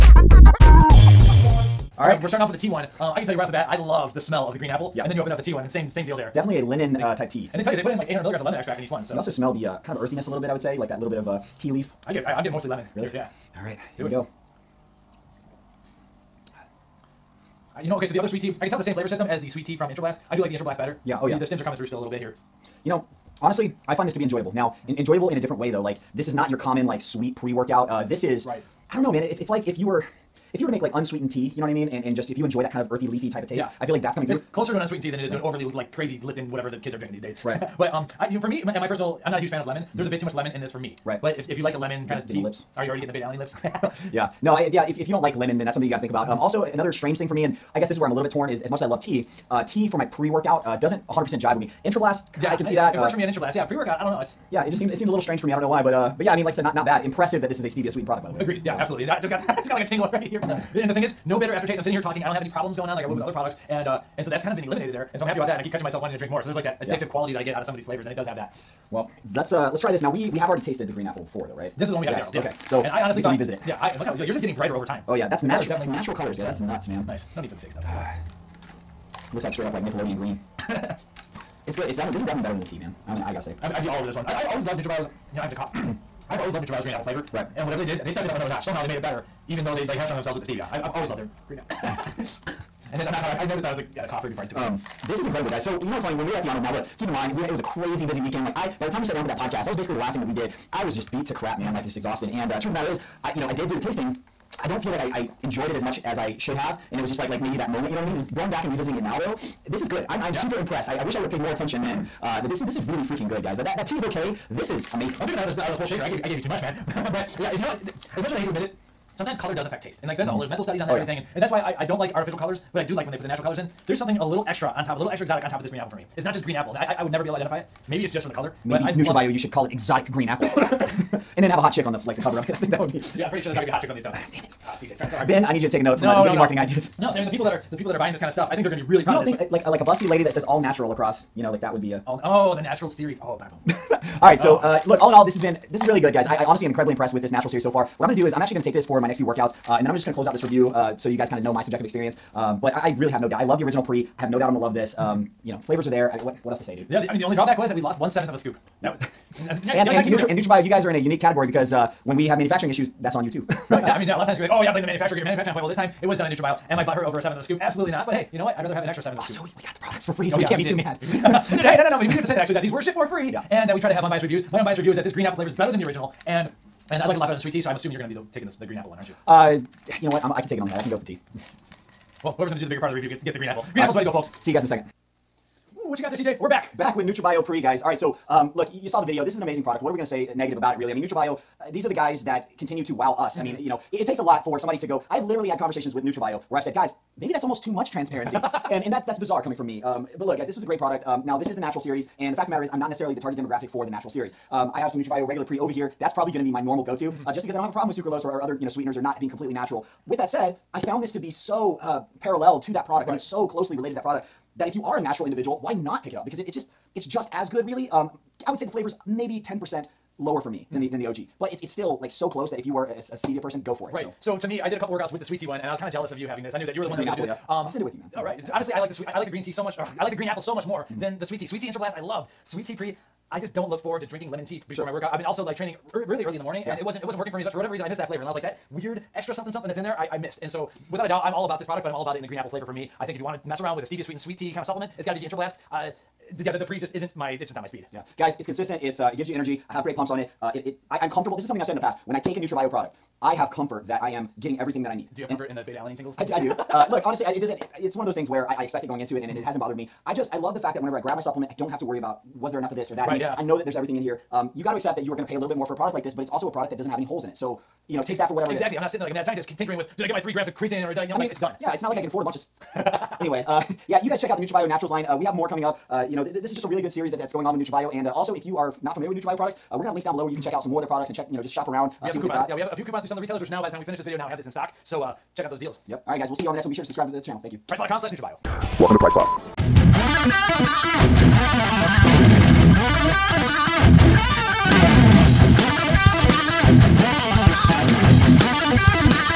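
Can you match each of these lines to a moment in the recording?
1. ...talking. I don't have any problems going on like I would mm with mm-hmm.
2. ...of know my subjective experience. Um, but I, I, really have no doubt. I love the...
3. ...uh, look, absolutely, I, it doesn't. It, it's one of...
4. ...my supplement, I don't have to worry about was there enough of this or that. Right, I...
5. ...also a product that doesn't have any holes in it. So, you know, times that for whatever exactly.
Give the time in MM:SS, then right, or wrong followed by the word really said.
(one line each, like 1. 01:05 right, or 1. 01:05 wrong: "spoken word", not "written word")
1. 01:02 right
2. 02:31 right
3. 04:16 wrong: "honestly", not "absolutely"
4. 04:21 right
5. 04:26 wrong: "takes", not "times".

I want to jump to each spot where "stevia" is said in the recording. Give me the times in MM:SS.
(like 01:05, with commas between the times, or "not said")
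00:57, 01:30, 03:43, 04:03.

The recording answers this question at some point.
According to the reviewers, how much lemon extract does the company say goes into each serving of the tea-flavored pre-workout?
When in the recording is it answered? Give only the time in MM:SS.
00:08.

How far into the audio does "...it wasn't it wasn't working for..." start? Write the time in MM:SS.
03:56.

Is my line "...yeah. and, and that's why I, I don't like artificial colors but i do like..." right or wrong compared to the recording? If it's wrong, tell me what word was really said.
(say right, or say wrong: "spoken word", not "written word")
right.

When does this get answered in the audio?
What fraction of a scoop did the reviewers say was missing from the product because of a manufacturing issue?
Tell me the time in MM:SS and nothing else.
02:37.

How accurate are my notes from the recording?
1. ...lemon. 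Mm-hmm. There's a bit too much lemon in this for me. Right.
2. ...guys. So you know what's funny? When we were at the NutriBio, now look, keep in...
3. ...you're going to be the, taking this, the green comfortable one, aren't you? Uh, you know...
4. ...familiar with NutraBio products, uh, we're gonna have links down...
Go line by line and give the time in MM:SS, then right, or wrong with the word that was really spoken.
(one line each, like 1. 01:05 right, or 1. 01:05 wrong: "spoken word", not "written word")
1. 00:39 right
2. 01:35 wrong: "Arnold", not "NutriBio"
3. 02:57 wrong: "apple", not "comfortable"
4. 04:38 right.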